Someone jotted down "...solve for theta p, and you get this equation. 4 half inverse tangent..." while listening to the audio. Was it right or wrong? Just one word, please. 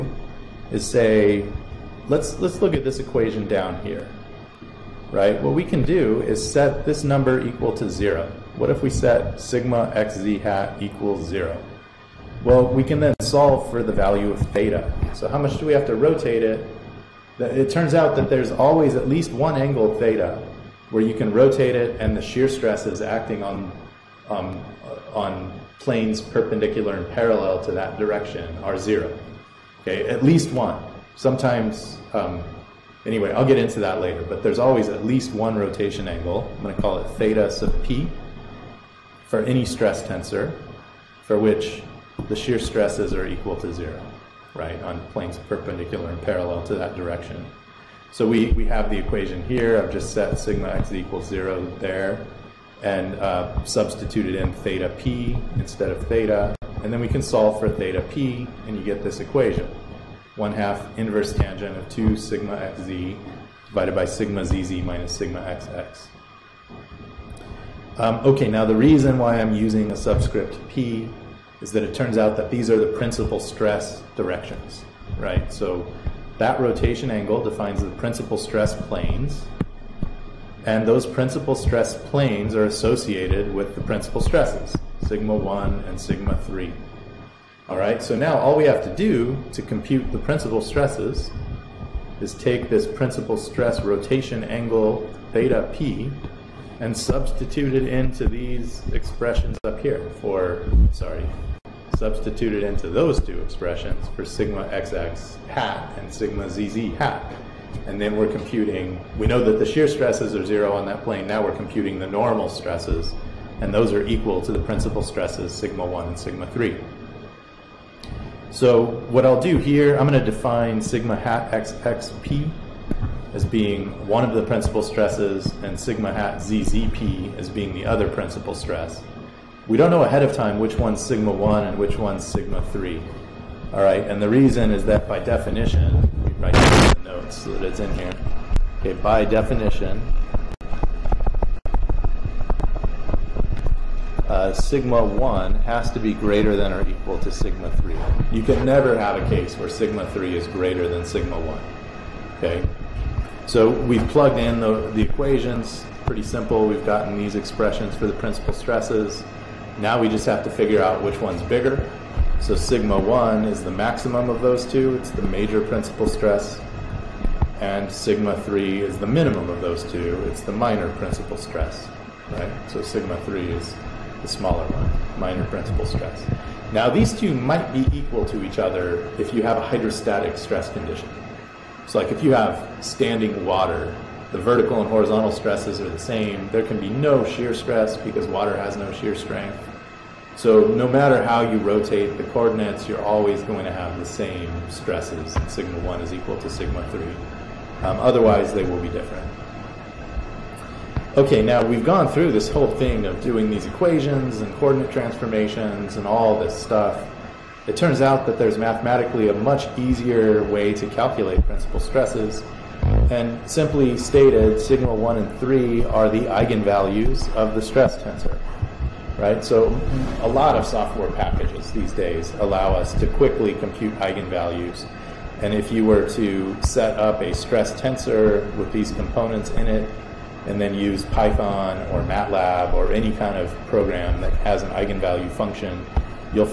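wrong.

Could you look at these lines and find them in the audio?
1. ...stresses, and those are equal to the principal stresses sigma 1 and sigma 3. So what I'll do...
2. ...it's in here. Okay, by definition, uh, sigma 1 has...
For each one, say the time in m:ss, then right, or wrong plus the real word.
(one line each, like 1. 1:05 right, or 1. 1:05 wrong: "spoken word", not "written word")
1. 1:52 right
2. 2:17 right.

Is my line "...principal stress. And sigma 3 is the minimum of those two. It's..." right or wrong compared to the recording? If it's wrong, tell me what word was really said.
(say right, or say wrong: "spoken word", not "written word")
right.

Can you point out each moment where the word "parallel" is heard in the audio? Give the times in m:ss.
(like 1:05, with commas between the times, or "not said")
0:27, 0:46.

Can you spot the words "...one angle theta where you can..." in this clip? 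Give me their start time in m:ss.
0:19.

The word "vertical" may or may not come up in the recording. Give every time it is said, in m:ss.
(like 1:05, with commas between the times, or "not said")
3:04.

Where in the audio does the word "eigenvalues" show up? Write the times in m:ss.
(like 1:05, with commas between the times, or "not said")
3:36, 3:43, 3:54.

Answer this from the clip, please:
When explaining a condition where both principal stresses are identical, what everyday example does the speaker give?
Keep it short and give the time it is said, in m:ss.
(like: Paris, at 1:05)
standing water, at 3:02.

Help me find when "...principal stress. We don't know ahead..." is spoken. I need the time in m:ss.
2:08.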